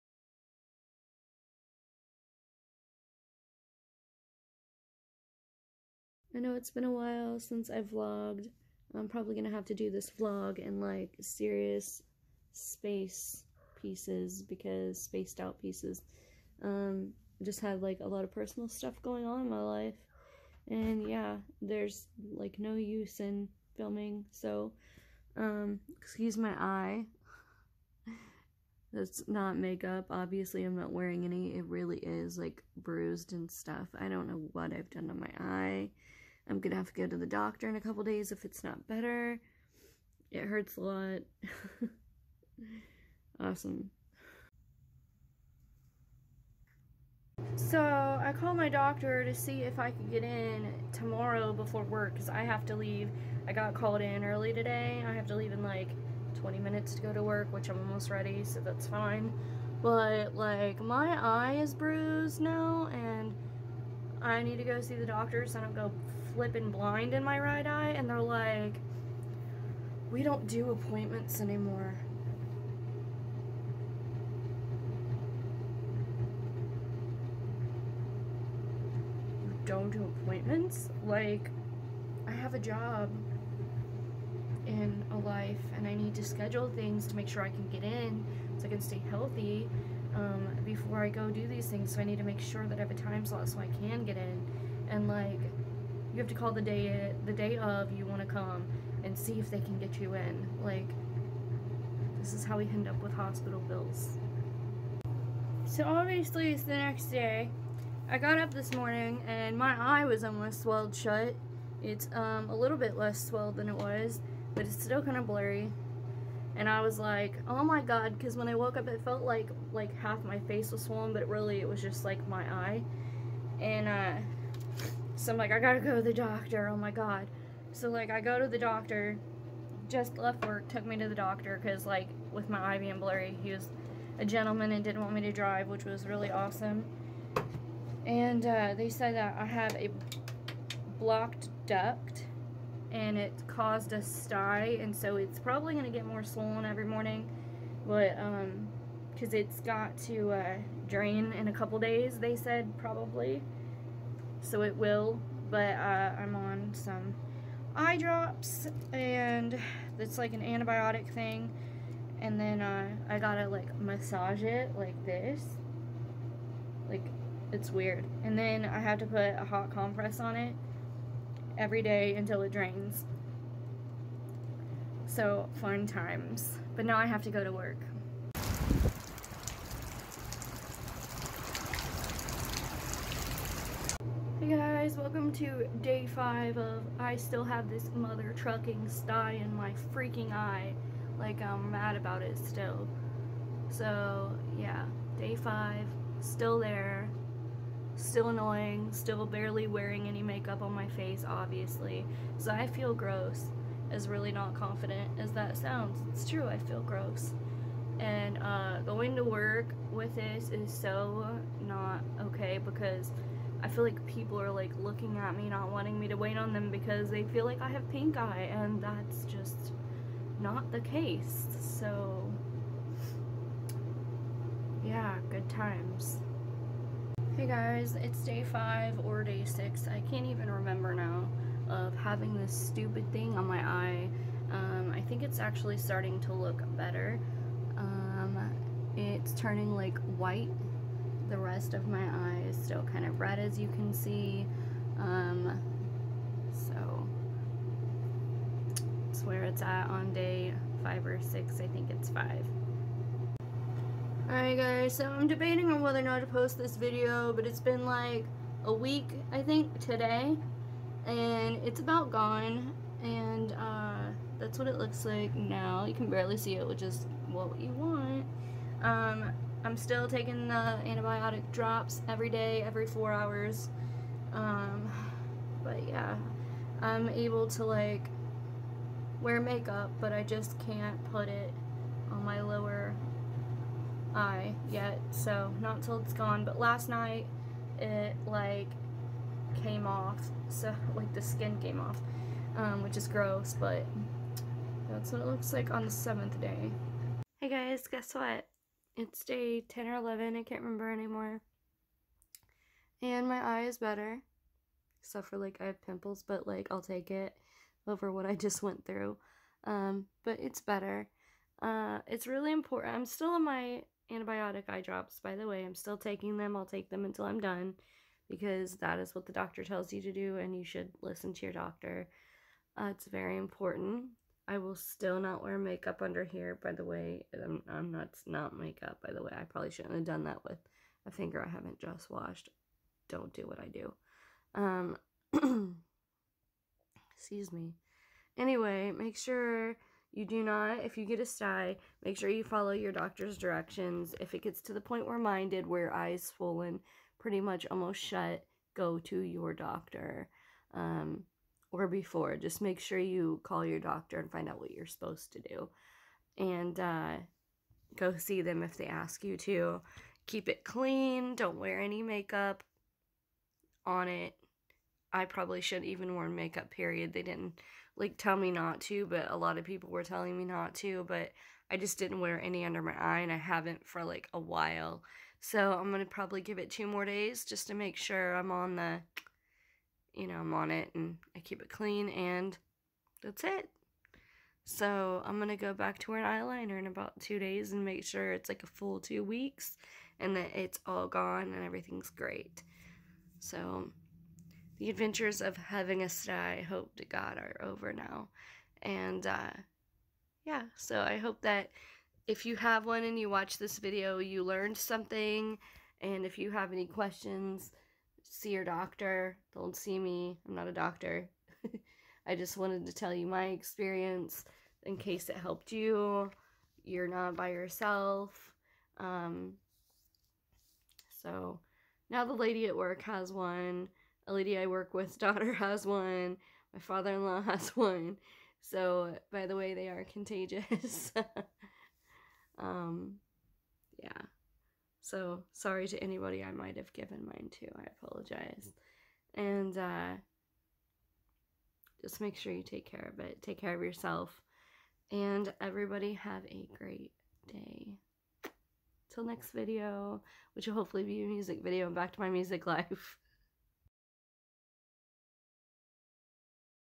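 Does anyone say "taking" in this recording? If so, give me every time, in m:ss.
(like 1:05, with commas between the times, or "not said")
4:30, 5:15.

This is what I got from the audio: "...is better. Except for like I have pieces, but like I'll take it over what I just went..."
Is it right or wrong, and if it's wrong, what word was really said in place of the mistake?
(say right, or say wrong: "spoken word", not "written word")
wrong: "pimples", not "pieces".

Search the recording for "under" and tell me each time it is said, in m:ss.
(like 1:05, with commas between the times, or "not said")
5:26, 6:12.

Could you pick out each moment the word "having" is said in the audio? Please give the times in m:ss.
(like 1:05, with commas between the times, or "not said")
3:51, 6:35.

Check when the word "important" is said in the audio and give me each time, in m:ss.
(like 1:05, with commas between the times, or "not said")
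5:12, 5:23.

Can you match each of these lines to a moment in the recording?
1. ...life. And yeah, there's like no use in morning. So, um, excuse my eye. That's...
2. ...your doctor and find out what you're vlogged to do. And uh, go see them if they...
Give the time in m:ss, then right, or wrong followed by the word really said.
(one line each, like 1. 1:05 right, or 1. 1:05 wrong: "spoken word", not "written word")
1. 0:19 wrong: "filming", not "morning"
2. 5:53 wrong: "supposed", not "vlogged".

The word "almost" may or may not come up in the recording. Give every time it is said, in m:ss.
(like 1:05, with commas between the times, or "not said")
0:57, 1:50, 5:47.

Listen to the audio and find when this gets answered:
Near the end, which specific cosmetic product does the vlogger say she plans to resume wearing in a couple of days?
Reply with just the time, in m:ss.
6:26.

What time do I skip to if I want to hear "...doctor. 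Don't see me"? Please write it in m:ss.
6:48.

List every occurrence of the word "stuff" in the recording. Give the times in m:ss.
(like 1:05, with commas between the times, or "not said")
0:18, 0:33.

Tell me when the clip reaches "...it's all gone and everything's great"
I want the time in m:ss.
6:30.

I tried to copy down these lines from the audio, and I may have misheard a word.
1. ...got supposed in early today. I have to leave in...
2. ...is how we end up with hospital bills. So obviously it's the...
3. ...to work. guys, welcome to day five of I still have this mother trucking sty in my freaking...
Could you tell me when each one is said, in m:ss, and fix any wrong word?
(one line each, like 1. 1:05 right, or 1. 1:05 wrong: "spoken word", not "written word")
1. 0:53 wrong: "called", not "supposed"
2. 1:42 right
3. 2:57 right.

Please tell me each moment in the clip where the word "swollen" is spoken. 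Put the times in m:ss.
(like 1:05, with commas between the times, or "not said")
2:00, 2:26, 5:46.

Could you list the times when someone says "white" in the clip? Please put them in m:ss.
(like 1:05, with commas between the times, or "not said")
4:00.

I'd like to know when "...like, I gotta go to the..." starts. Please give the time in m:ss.
2:05.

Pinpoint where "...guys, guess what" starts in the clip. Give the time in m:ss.
4:57.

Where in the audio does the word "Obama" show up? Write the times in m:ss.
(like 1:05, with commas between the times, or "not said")
not said.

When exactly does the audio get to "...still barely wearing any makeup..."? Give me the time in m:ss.
3:18.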